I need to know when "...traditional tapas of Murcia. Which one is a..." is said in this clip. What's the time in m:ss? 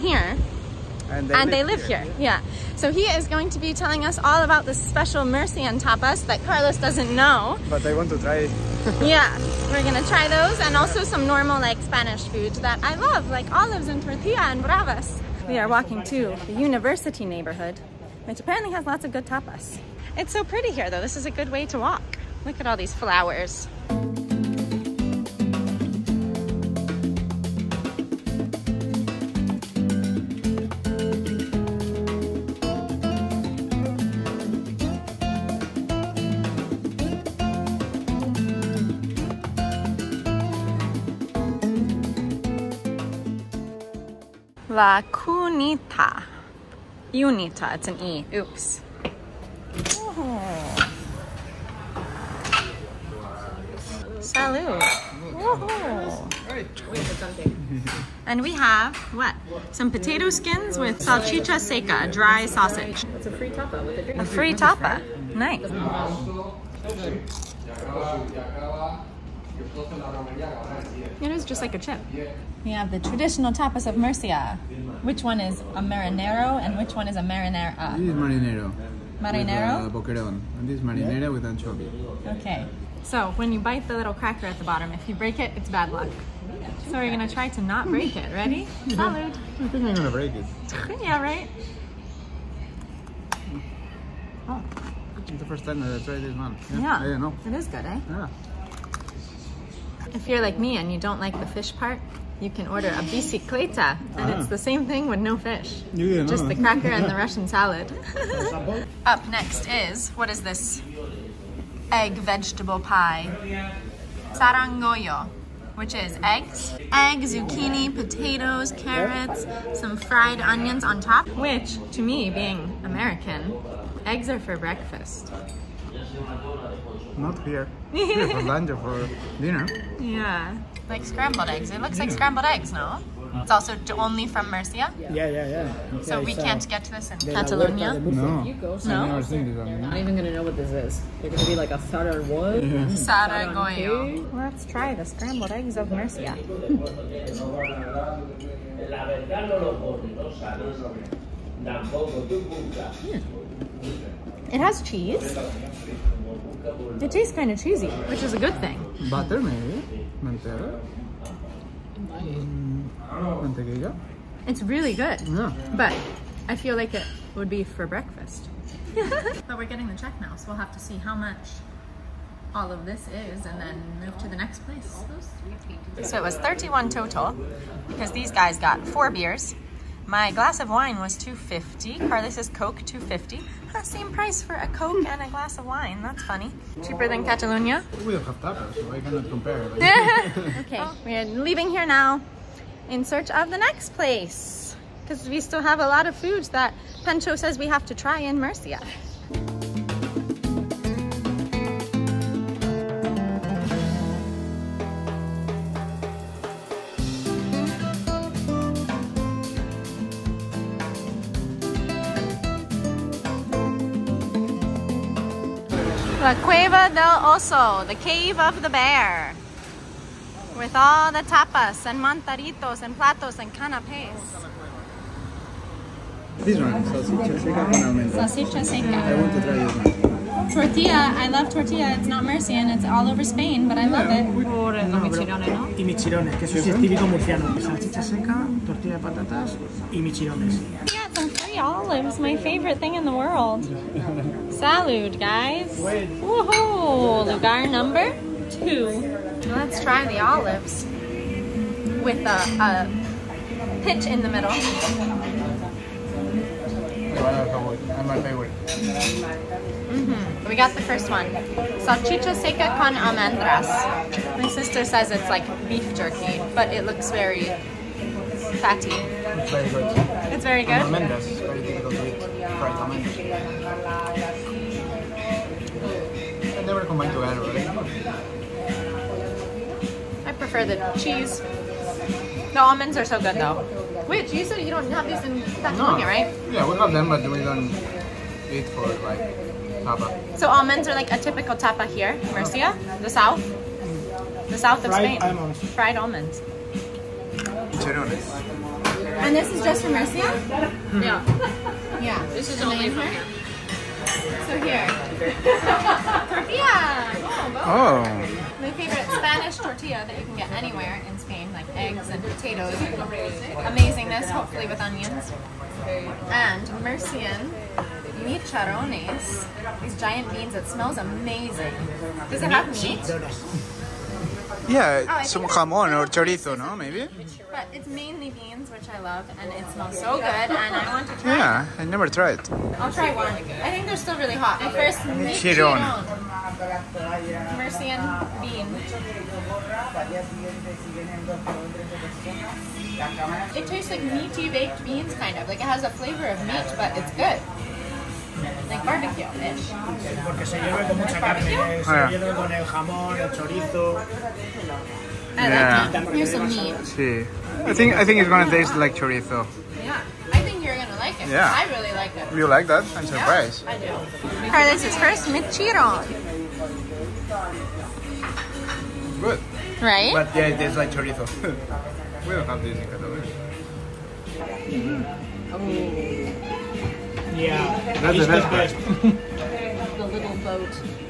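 1:12.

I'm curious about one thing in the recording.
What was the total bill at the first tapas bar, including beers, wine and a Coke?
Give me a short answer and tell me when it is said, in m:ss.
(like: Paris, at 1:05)
31, at 2:56.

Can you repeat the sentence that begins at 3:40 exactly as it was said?
With all the tapas and mantaritos and platos and canapes.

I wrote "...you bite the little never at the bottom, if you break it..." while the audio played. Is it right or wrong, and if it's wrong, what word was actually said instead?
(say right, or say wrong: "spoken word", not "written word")
wrong: "cracker", not "never".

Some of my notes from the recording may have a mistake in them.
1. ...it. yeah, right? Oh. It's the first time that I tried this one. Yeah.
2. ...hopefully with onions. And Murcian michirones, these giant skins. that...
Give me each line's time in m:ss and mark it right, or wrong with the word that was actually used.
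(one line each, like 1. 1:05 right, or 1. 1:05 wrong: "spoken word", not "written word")
1. 1:30 right
2. 5:14 wrong: "beans", not "skins".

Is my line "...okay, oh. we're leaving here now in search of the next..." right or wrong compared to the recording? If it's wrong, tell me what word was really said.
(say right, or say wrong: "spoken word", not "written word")
right.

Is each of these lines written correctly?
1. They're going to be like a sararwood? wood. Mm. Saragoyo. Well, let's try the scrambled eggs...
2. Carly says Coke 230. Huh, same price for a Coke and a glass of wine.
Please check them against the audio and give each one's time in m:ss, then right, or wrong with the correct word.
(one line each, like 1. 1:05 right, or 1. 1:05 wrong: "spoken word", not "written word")
1. 2:21 right
2. 3:02 wrong: "250", not "230".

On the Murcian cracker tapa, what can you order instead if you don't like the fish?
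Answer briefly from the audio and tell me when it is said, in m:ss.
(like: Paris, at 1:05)
Bicicleta, at 1:43.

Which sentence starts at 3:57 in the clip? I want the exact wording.
Salsicha seca, tortilla de patatas y michirones.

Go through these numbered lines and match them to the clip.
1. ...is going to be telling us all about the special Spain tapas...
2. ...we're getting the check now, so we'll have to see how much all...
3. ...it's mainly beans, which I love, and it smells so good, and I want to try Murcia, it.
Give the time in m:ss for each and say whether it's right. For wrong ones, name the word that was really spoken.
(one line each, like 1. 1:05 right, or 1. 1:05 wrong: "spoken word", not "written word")
1. 0:03 wrong: "Murcian", not "Spain"
2. 2:49 right
3. 5:27 wrong: "Yeah", not "Murcia".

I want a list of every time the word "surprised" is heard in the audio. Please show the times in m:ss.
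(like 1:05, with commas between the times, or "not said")
6:03.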